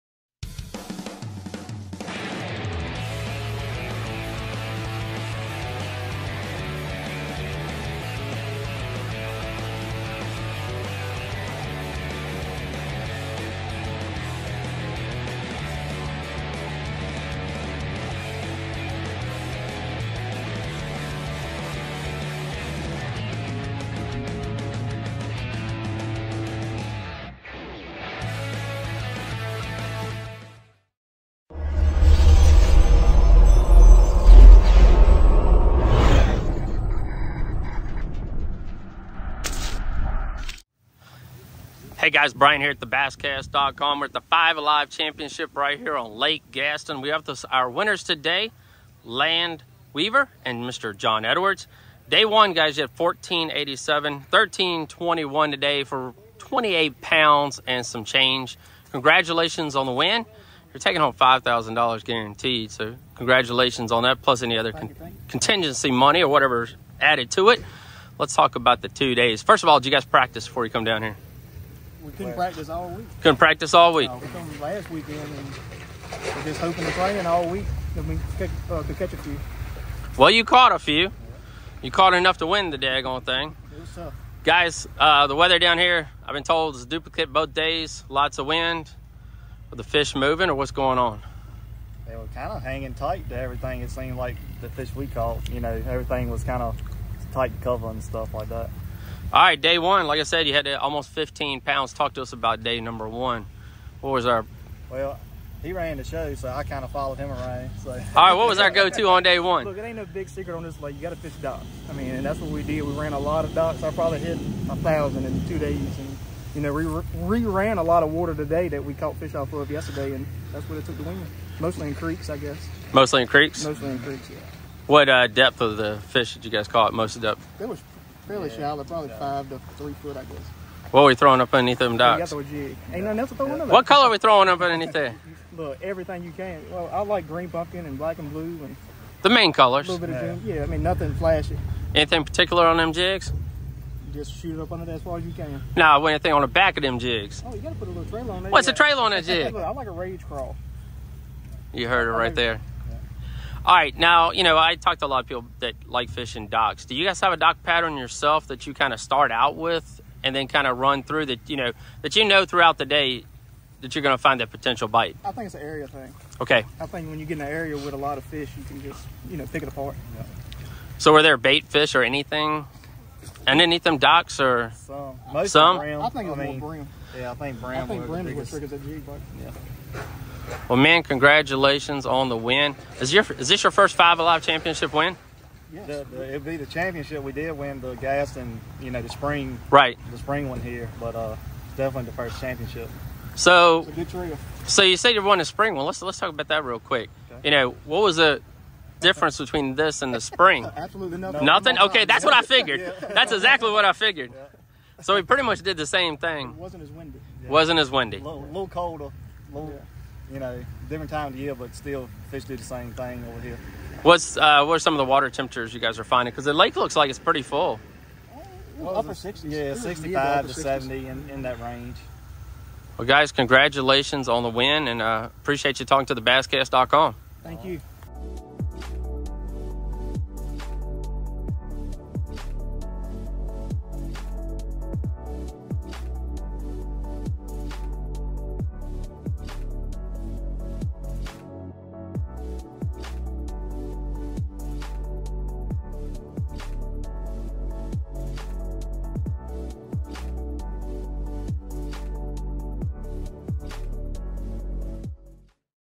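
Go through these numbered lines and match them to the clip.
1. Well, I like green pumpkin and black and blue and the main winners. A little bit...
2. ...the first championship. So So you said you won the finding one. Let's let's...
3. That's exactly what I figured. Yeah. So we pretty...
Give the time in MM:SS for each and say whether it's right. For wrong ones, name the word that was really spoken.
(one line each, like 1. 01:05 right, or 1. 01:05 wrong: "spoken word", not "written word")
1. 02:16 wrong: "colors", not "winners"
2. 03:12 wrong: "spring", not "finding"
3. 03:23 right.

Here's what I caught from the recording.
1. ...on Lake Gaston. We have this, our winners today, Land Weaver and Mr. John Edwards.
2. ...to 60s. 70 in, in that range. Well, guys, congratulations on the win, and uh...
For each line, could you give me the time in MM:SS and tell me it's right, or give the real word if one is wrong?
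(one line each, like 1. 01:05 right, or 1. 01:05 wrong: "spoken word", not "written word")
1. 00:45 right
2. 03:40 right.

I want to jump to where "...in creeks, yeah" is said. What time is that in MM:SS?
02:03.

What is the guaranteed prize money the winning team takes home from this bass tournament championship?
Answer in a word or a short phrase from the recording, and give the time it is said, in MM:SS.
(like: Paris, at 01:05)
$5,000, at 01:01.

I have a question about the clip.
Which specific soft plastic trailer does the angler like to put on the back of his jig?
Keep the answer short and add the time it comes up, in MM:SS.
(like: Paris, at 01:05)
Rage Craw, at 02:29.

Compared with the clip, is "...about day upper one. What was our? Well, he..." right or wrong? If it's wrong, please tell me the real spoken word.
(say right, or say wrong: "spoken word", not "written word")
wrong: "number", not "upper".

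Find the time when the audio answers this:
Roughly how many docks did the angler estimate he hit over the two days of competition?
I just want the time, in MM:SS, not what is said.
01:54.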